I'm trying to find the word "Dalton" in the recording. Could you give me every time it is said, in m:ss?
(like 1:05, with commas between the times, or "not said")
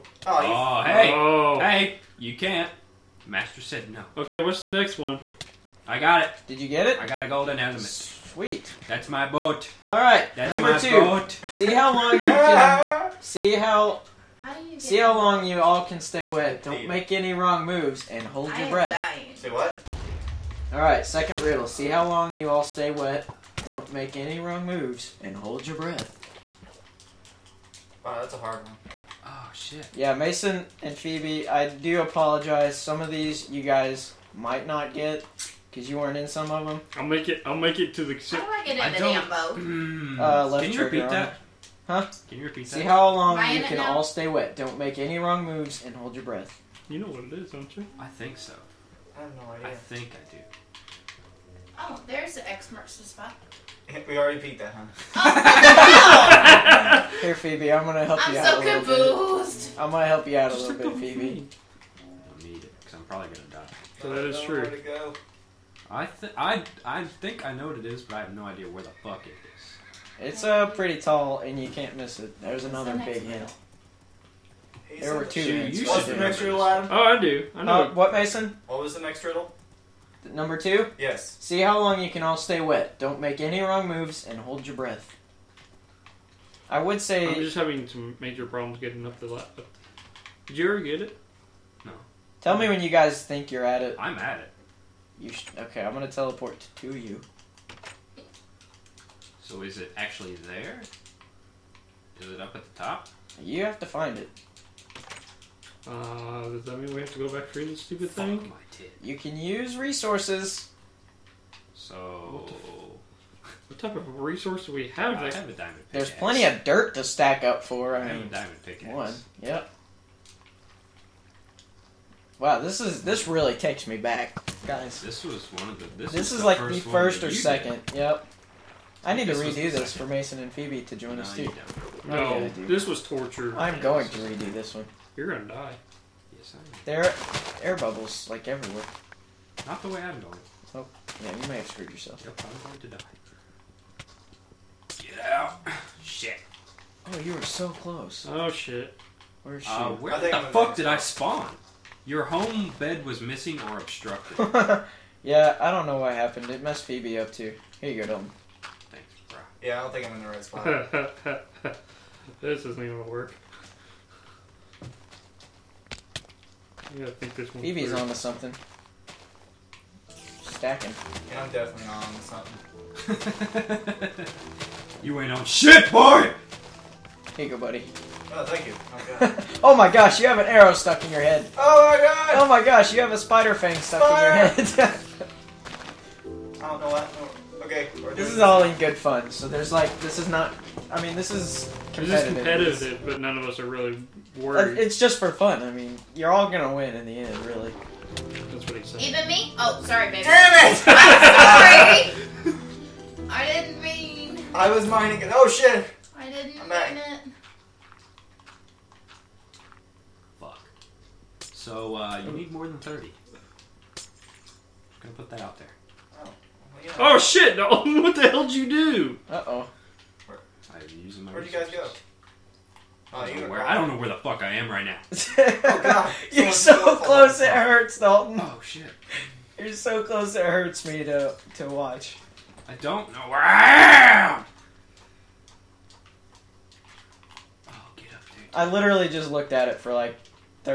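2:38, 3:47.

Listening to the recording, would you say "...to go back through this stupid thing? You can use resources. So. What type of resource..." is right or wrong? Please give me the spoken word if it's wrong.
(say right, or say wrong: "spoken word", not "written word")
right.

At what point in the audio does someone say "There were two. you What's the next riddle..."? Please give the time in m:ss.
1:14.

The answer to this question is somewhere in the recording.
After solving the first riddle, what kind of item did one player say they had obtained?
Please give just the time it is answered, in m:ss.
0:07.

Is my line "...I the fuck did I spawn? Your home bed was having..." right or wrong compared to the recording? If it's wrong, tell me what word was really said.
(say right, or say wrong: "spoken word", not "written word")
wrong: "missing", not "having".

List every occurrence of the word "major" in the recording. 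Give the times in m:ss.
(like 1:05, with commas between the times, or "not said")
1:28.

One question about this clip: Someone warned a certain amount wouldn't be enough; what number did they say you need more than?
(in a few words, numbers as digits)
30.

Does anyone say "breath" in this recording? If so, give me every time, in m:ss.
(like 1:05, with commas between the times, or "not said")
0:18, 0:25, 0:46, 1:24.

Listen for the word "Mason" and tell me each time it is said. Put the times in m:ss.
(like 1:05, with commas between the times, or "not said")
0:30, 1:18, 2:10.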